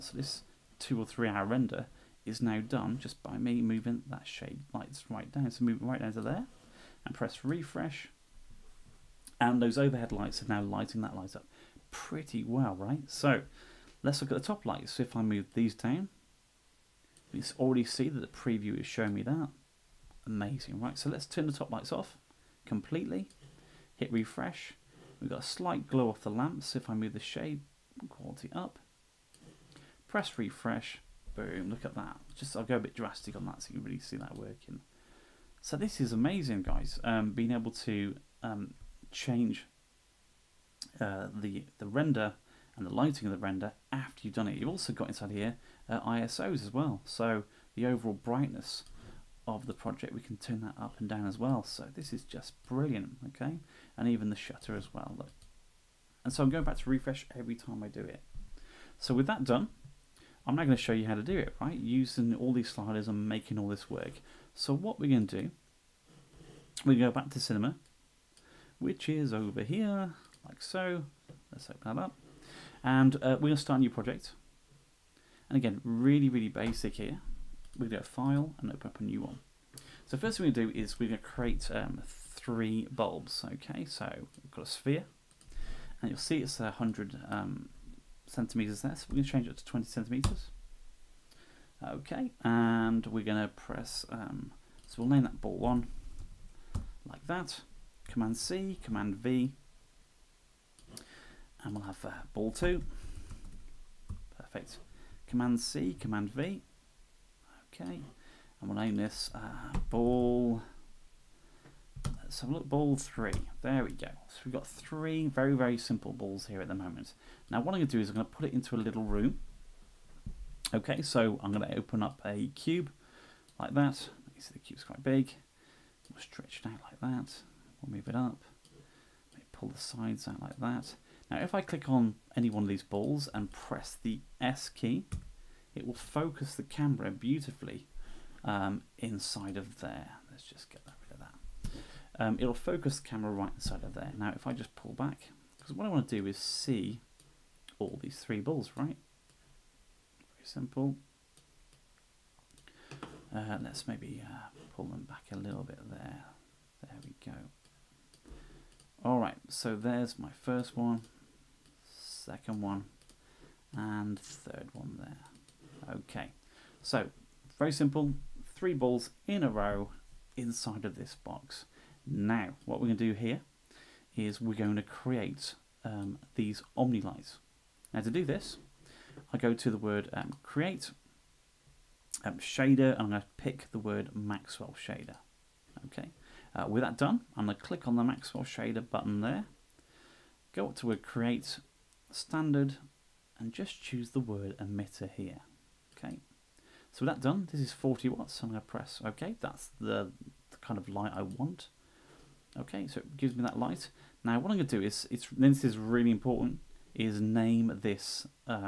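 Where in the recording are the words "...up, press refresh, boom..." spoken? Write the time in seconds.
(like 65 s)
28 s.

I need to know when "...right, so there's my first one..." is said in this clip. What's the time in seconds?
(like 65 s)
159 s.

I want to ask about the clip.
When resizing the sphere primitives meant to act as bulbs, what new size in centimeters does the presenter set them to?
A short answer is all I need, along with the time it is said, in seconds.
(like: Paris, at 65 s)
20 centimeters, at 89 s.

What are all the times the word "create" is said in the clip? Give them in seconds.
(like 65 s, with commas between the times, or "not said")
81 s, 174 s, 180 s, 191 s.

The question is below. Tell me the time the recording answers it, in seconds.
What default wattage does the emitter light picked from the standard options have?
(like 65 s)
197 s.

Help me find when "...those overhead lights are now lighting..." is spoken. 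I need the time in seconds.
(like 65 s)
9 s.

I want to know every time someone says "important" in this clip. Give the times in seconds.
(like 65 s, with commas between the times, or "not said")
206 s.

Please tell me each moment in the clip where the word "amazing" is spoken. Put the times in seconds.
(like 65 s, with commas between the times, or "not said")
20 s, 36 s.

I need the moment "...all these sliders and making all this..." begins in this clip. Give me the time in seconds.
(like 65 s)
62 s.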